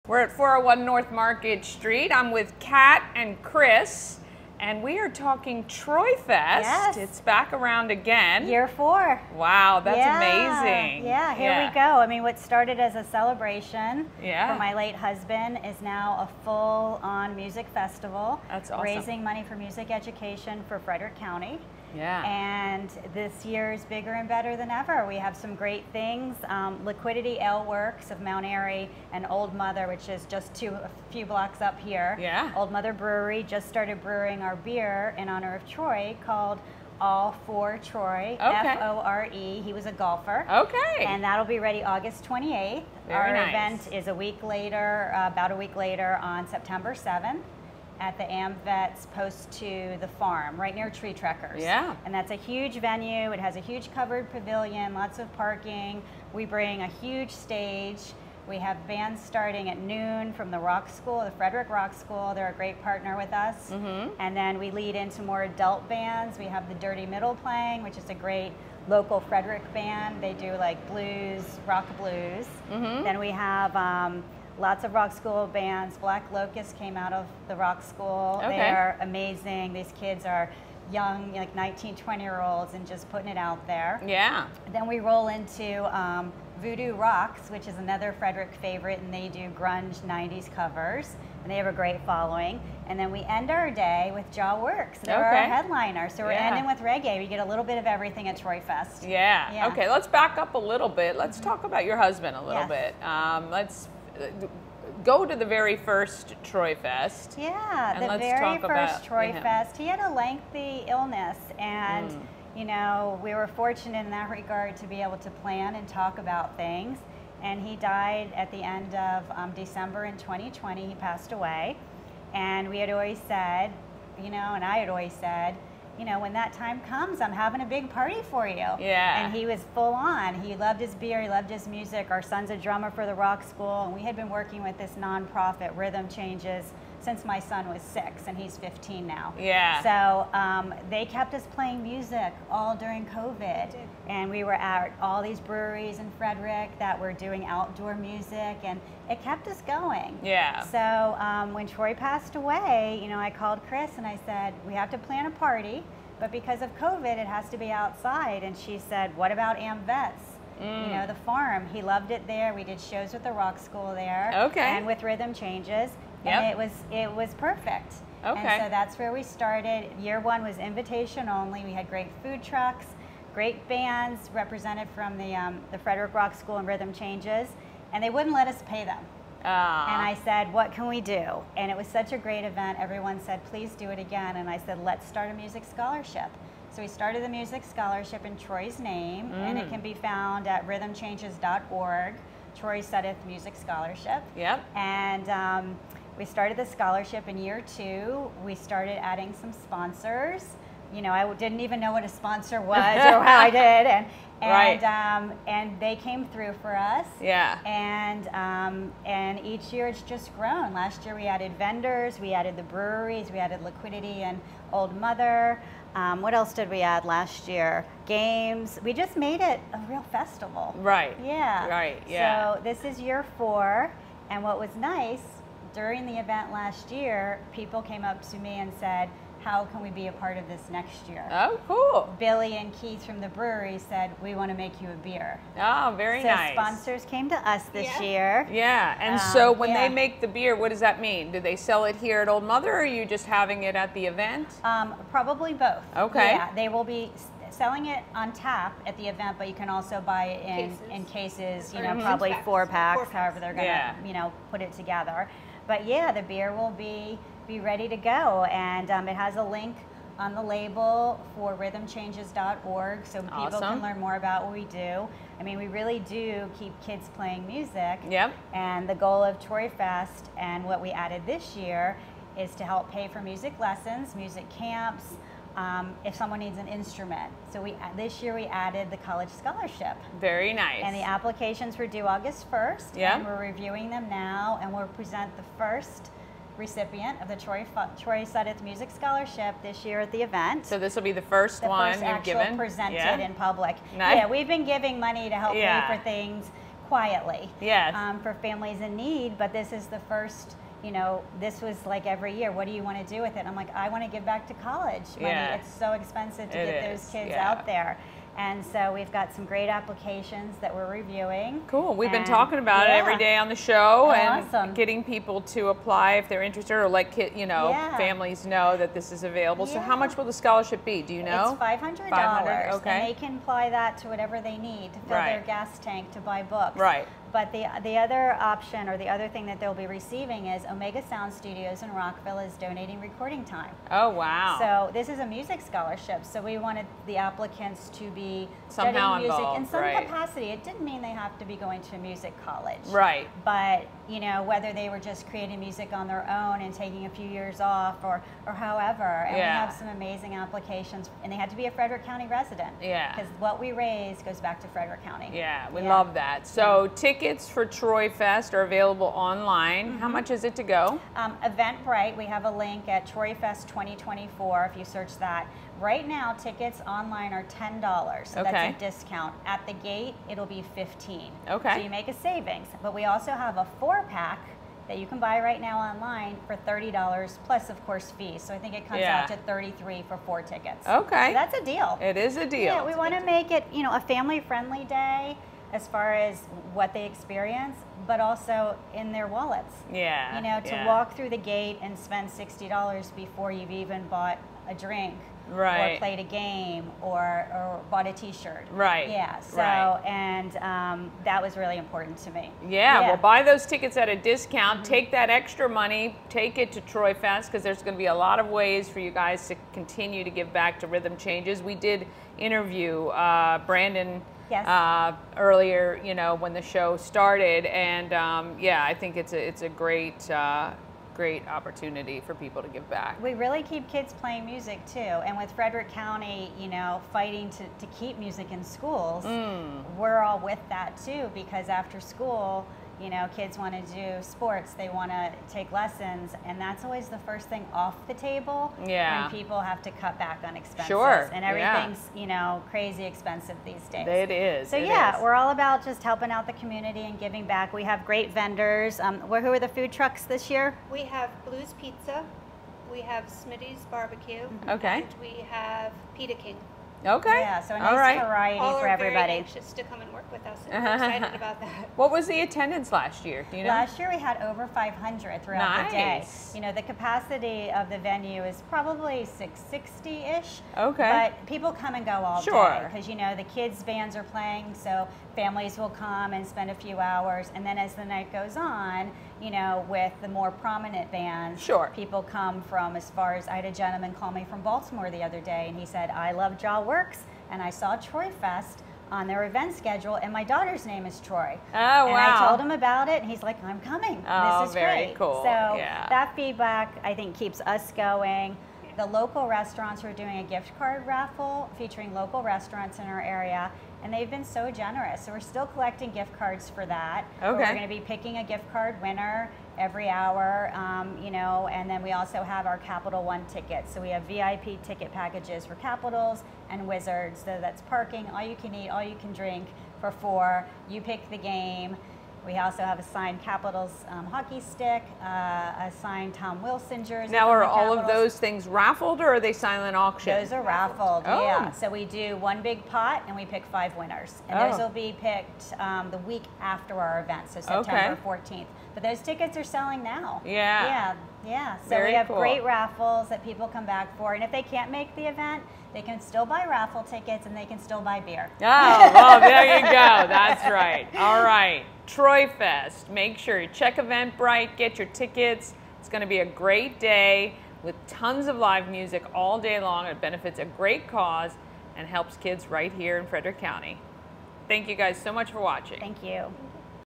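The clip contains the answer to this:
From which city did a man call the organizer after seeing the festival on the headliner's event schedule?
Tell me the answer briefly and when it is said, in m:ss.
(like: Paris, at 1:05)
Baltimore, at 8:04.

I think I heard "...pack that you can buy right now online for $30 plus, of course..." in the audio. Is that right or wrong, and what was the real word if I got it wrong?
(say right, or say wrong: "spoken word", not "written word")
right.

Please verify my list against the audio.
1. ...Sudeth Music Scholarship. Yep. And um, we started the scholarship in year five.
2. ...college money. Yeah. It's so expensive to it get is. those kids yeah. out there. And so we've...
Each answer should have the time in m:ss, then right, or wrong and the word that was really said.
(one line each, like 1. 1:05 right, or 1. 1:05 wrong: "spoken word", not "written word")
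1. 3:12 wrong: "two", not "five"
2. 5:04 right.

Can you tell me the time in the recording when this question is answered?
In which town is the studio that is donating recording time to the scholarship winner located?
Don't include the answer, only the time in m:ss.
5:31.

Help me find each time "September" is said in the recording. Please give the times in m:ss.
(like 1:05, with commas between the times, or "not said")
0:46, 8:57.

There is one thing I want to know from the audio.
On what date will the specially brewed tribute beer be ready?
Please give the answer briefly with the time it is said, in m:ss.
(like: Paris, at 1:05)
August 28, at 0:41.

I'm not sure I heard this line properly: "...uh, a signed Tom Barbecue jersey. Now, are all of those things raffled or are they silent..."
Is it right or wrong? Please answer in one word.
wrong.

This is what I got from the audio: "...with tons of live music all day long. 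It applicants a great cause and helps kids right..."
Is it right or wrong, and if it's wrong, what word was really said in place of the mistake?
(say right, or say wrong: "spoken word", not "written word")
wrong: "benefits", not "applicants".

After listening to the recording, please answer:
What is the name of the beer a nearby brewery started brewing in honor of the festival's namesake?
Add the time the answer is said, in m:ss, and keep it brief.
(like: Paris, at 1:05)
All for Troy, at 0:36.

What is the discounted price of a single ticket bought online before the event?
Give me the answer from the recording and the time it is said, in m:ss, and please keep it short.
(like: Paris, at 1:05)
$10, at 6:07.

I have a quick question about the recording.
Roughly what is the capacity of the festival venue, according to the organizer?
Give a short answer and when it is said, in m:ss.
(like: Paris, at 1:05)
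660, at 7:49.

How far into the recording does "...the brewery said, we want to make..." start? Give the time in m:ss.
3:53.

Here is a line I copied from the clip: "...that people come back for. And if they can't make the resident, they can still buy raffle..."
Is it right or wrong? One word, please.
wrong.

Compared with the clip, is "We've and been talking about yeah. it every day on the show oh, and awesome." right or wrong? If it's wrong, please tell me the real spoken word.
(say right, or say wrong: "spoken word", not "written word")
right.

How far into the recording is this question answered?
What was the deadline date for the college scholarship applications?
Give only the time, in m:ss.
4:42.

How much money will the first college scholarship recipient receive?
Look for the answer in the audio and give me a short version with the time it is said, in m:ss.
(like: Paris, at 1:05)
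$500, at 5:21.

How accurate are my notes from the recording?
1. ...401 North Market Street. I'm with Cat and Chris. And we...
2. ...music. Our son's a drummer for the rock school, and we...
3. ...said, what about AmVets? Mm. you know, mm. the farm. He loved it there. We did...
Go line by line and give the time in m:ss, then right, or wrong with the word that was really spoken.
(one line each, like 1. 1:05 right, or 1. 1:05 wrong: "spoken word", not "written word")
1. 0:00 right
2. 2:11 right
3. 2:38 right.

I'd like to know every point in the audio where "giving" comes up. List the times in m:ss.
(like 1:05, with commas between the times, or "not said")
4:54, 7:27.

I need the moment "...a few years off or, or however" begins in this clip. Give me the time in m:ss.
5:47.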